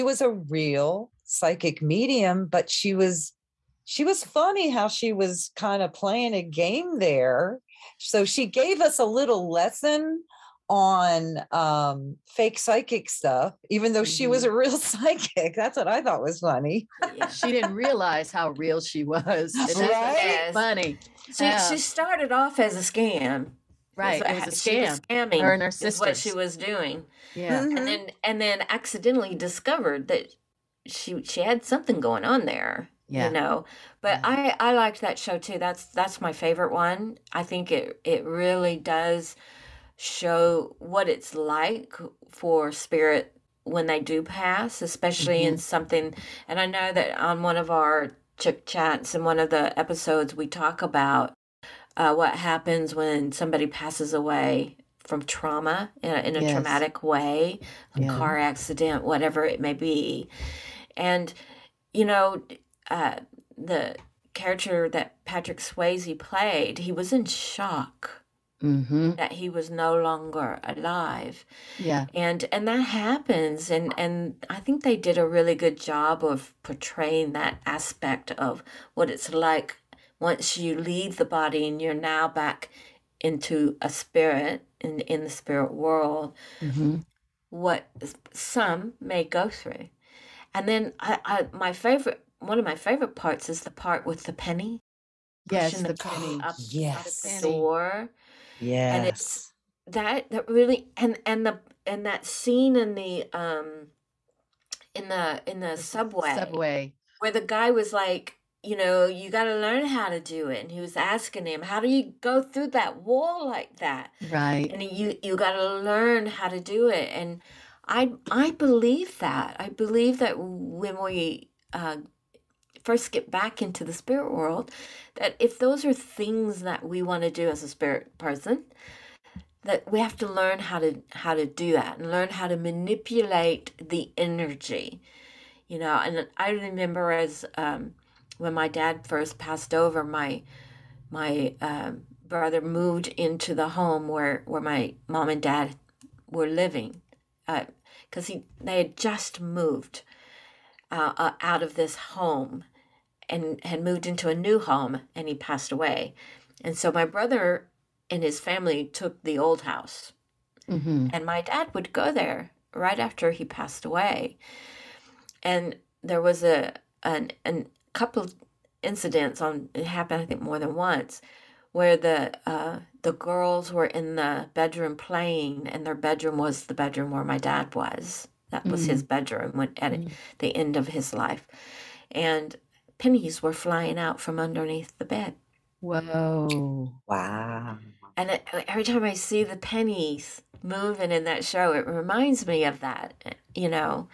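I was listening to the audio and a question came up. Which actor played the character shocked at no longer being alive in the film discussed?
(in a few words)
Patrick Swayze.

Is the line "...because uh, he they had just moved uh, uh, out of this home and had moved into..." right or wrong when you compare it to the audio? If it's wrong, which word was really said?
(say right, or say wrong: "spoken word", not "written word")
right.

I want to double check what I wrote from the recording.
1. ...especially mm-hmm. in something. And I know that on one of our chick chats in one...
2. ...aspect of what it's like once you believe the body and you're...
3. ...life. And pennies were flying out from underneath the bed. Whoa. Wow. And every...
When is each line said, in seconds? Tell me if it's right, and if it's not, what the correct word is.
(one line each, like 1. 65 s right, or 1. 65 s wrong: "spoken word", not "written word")
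1. 44 s right
2. 77 s wrong: "leave", not "believe"
3. 181 s right.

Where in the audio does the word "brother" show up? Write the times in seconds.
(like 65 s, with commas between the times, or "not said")
142 s, 157 s.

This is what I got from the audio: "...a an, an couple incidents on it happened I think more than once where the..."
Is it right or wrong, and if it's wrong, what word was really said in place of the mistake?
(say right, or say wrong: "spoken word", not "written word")
right.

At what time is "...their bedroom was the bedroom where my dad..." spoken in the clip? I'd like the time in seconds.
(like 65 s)
175 s.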